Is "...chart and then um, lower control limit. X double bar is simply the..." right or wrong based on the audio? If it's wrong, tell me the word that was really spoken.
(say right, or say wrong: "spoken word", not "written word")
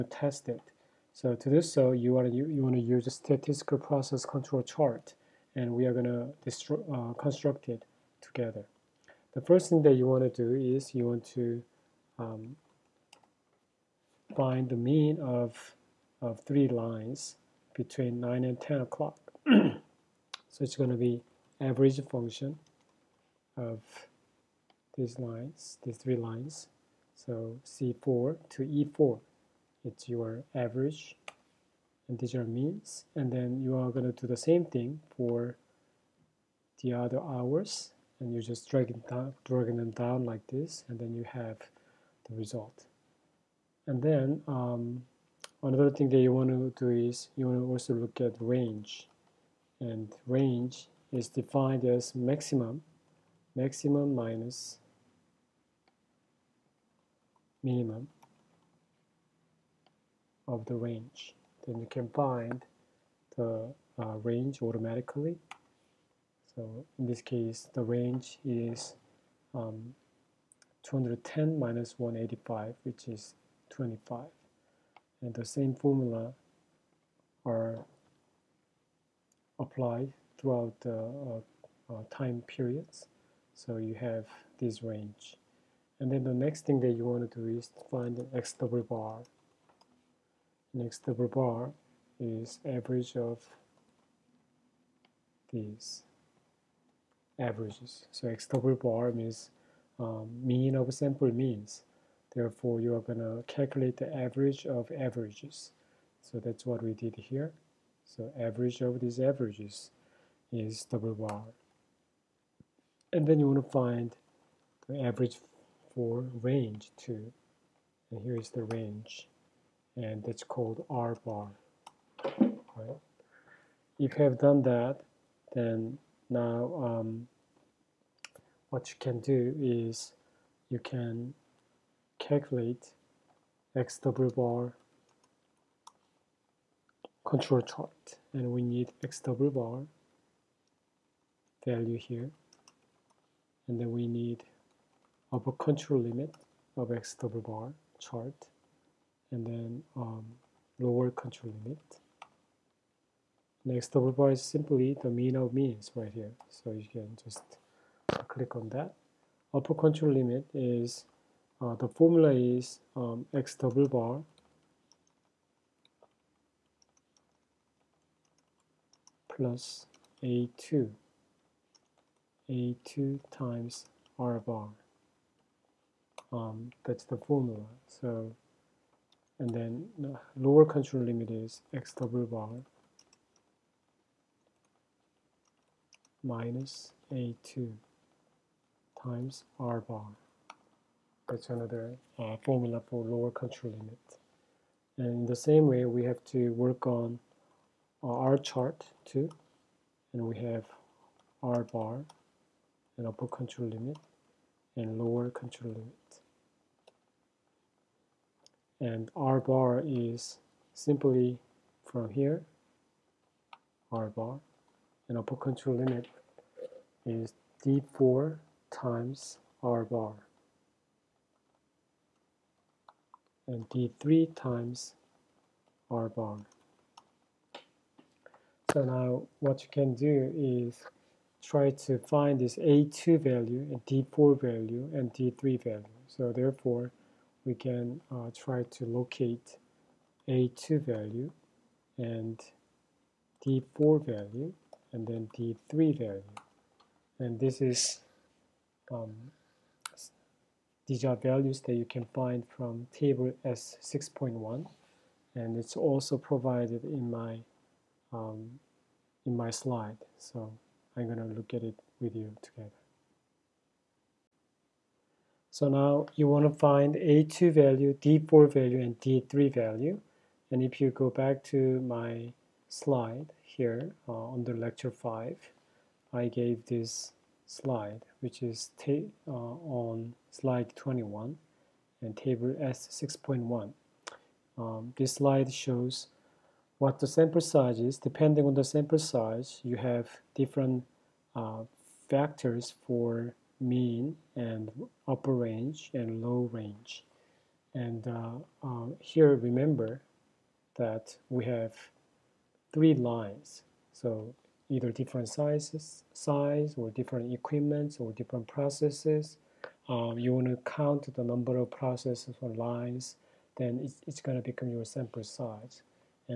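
right.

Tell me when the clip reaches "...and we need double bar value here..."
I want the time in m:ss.
2:18.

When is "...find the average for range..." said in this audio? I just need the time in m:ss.
1:53.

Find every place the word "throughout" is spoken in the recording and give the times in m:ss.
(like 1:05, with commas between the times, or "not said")
1:20.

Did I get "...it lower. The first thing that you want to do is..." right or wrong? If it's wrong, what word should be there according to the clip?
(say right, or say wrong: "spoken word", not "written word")
wrong: "together", not "lower".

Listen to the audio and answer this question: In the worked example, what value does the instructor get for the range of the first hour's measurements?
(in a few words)
25.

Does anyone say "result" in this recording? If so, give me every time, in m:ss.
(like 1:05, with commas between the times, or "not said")
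0:42.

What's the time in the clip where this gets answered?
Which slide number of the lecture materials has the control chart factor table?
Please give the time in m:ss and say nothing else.
4:40.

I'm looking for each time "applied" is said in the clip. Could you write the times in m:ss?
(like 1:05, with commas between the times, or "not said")
1:19.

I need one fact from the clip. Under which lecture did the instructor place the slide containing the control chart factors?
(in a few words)
Lecture 5.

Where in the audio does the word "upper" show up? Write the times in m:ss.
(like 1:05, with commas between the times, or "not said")
2:25, 2:39, 3:23, 3:35, 4:55.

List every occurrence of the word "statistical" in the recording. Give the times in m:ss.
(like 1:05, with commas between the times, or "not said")
0:03.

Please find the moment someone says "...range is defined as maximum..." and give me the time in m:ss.
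0:50.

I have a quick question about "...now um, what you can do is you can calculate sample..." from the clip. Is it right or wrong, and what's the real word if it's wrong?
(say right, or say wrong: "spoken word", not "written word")
wrong: "double", not "sample".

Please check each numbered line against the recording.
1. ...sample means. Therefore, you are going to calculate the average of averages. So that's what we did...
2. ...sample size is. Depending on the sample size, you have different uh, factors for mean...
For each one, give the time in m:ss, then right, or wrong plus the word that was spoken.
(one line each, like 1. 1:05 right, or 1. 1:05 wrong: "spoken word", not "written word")
1. 1:40 right
2. 4:47 right.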